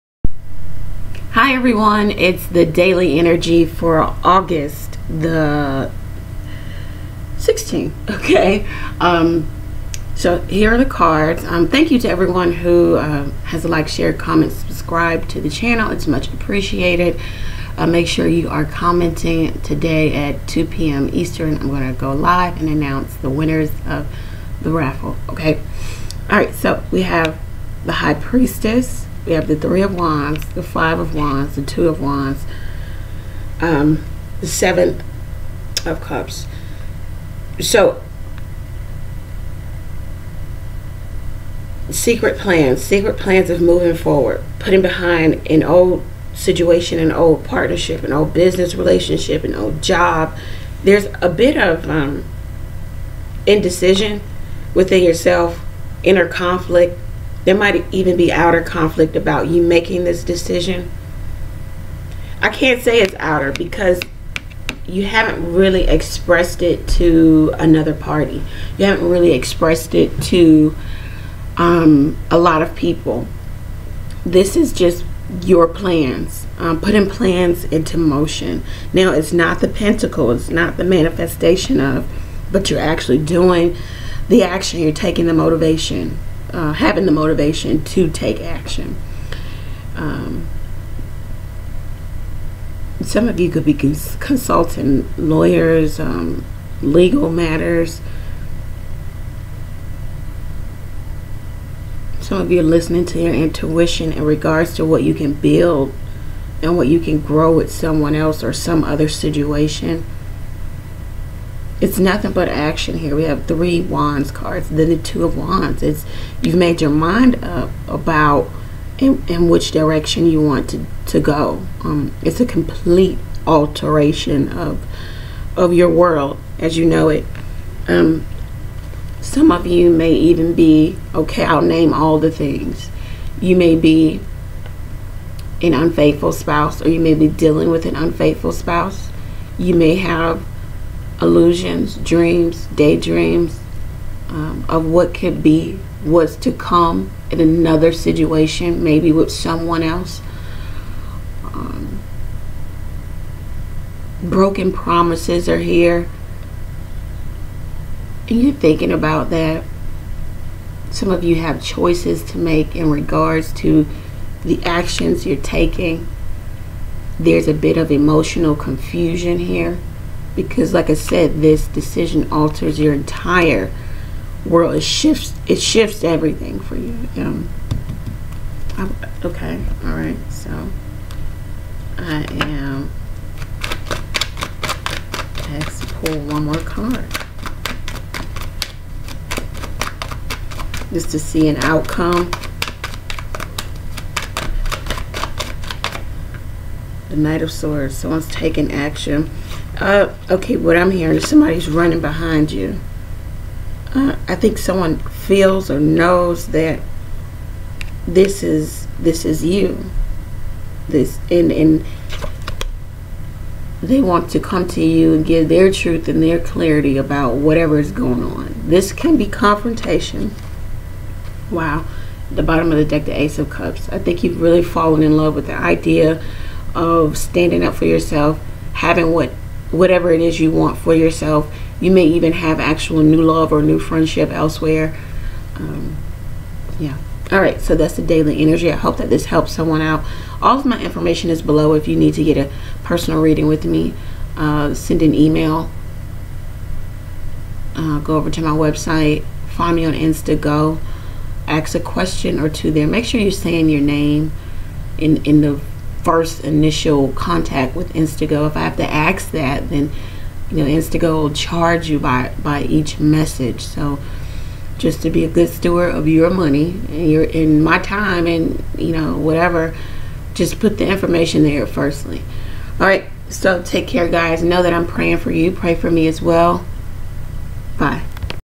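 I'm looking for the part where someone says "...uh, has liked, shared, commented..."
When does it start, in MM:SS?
00:12.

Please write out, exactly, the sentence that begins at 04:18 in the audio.
If I have to ask that, then you know InstantGo will charge you by by each message.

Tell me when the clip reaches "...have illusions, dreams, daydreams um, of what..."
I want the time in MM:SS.
02:19.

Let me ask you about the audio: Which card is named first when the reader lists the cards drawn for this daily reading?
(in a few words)
The High Priestess.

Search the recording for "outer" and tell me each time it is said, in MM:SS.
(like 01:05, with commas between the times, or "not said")
00:58, 01:03.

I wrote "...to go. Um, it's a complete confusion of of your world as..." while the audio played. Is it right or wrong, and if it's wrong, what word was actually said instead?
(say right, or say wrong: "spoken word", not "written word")
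wrong: "alteration", not "confusion".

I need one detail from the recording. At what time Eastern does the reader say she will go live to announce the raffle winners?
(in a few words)
2 p.m.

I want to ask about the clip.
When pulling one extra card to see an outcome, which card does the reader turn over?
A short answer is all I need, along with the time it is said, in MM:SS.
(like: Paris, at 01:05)
Knight of Swords, at 03:17.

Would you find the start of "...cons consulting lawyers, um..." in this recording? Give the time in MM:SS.
01:33.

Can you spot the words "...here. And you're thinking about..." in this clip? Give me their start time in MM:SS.
02:35.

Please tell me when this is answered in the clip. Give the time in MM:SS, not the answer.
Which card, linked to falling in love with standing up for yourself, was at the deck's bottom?
03:43.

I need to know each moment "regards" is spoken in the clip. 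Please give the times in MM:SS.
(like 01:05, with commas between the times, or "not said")
01:44, 02:42.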